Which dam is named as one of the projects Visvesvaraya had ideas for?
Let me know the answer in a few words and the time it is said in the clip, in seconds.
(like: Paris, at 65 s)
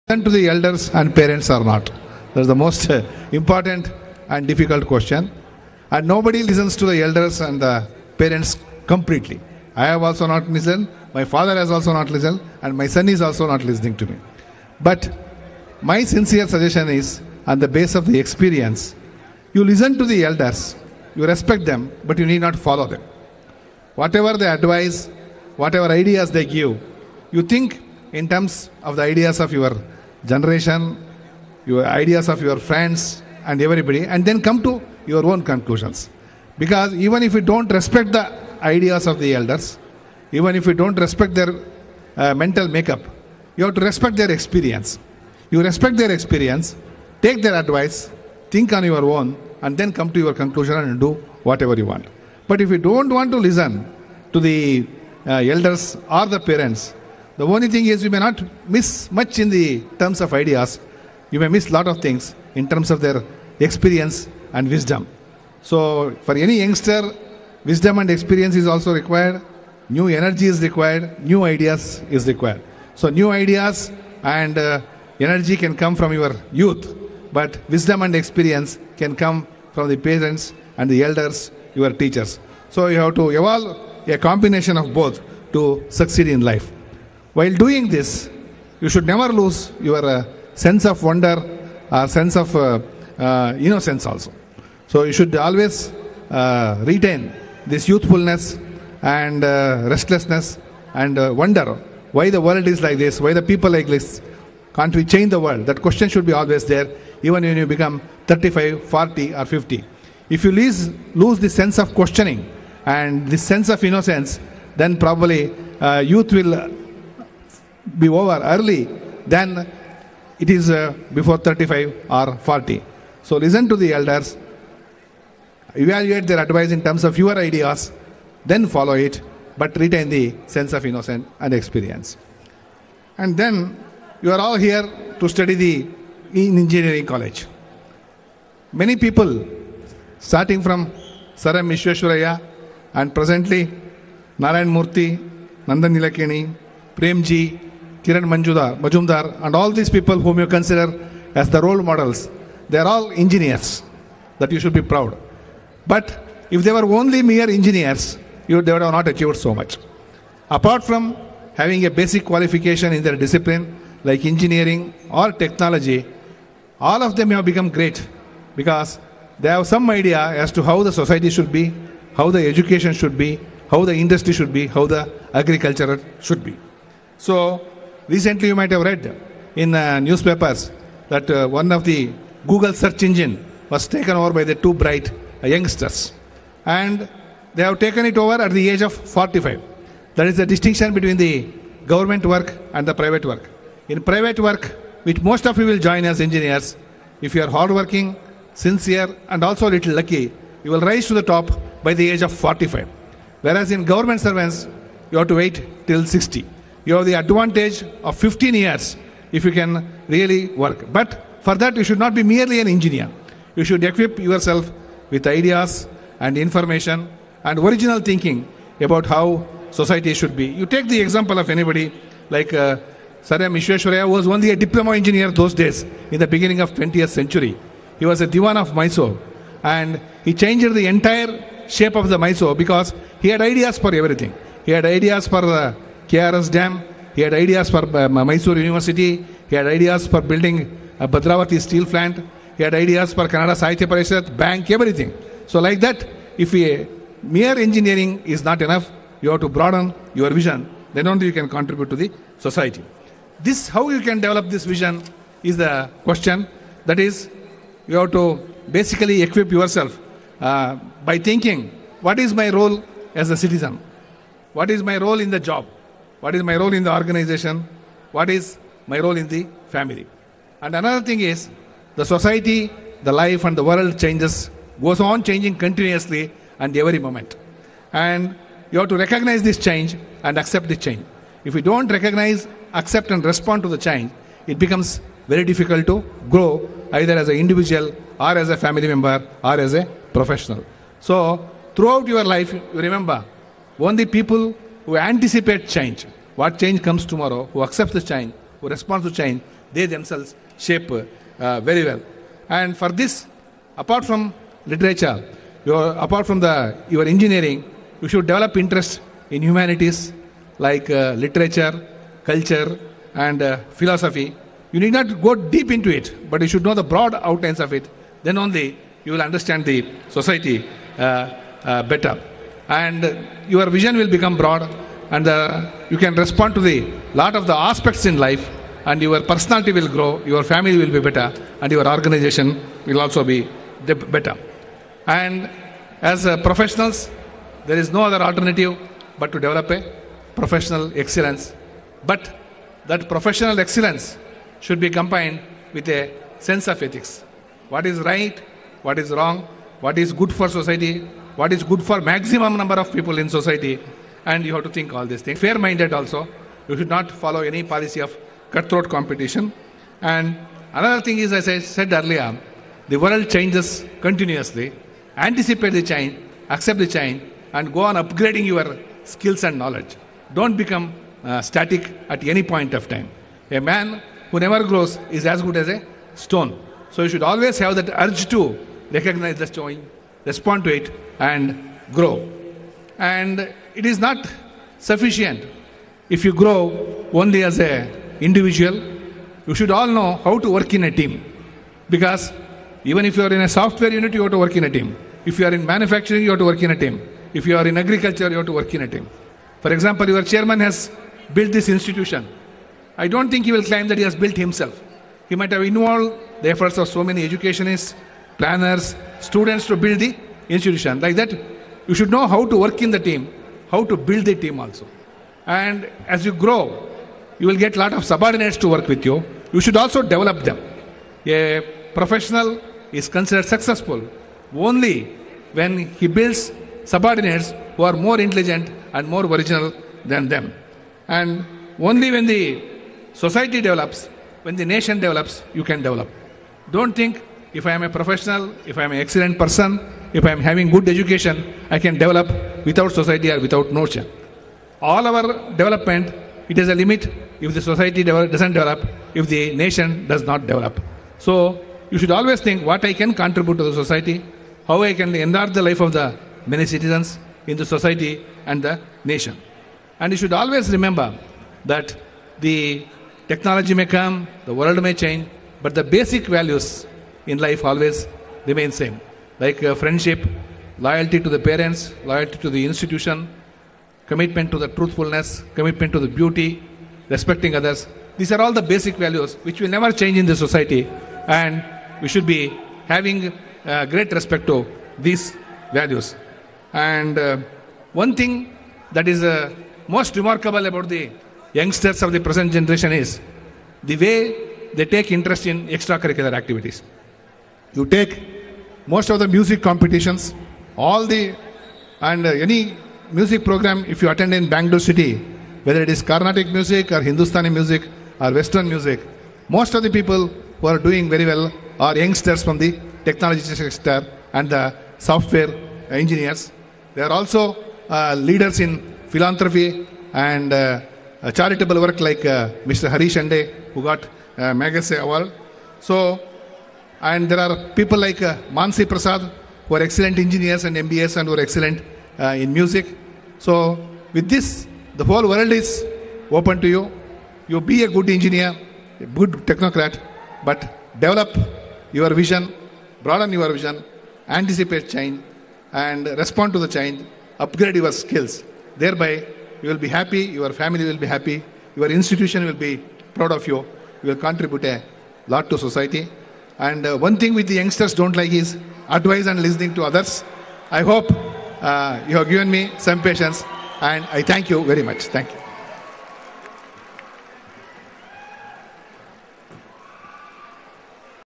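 KRS Dam, at 236 s.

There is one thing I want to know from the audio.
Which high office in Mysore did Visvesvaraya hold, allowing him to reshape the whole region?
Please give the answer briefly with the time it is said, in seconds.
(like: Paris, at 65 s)
Diwan of Mysore, at 228 s.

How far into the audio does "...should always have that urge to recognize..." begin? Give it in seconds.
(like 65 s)
377 s.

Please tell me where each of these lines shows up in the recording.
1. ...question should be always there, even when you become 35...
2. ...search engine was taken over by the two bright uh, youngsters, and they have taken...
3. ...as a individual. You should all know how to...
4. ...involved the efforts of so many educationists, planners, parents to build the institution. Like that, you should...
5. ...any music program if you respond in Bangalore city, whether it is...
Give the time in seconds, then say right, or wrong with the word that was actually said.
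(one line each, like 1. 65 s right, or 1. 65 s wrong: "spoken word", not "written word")
1. 105 s right
2. 182 s right
3. 387 s right
4. 405 s wrong: "students", not "parents"
5. 502 s wrong: "attend", not "respond".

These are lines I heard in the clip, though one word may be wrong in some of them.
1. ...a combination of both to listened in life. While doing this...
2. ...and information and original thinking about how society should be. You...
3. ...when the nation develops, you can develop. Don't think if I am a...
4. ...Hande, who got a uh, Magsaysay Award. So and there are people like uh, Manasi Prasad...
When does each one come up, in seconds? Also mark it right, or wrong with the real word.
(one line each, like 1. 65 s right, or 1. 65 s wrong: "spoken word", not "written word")
1. 84 s wrong: "succeed", not "listened"
2. 216 s right
3. 434 s right
4. 523 s right.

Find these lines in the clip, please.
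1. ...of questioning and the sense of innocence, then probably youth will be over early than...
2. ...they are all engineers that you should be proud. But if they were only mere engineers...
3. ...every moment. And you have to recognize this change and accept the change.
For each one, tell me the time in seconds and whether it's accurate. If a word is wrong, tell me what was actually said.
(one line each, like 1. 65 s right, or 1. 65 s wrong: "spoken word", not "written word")
1. 111 s right
2. 152 s right
3. 276 s right.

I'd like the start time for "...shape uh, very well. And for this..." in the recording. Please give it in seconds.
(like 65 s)
300 s.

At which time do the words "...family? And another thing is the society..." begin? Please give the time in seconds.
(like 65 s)
269 s.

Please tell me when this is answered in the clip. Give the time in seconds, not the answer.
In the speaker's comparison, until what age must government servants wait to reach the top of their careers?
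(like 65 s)
205 s.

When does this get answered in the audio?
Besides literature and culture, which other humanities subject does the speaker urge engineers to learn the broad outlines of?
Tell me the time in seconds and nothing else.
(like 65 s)
313 s.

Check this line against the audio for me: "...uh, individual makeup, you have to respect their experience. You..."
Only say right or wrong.
wrong.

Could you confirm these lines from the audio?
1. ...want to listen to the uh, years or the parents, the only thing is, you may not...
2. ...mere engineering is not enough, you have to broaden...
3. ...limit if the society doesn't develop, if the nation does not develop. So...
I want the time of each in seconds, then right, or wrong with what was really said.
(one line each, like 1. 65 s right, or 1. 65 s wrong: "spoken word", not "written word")
1. 53 s wrong: "elders", not "years"
2. 247 s right
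3. 446 s right.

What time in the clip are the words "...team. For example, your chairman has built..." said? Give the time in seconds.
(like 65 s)
398 s.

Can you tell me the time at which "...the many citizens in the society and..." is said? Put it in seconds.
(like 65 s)
455 s.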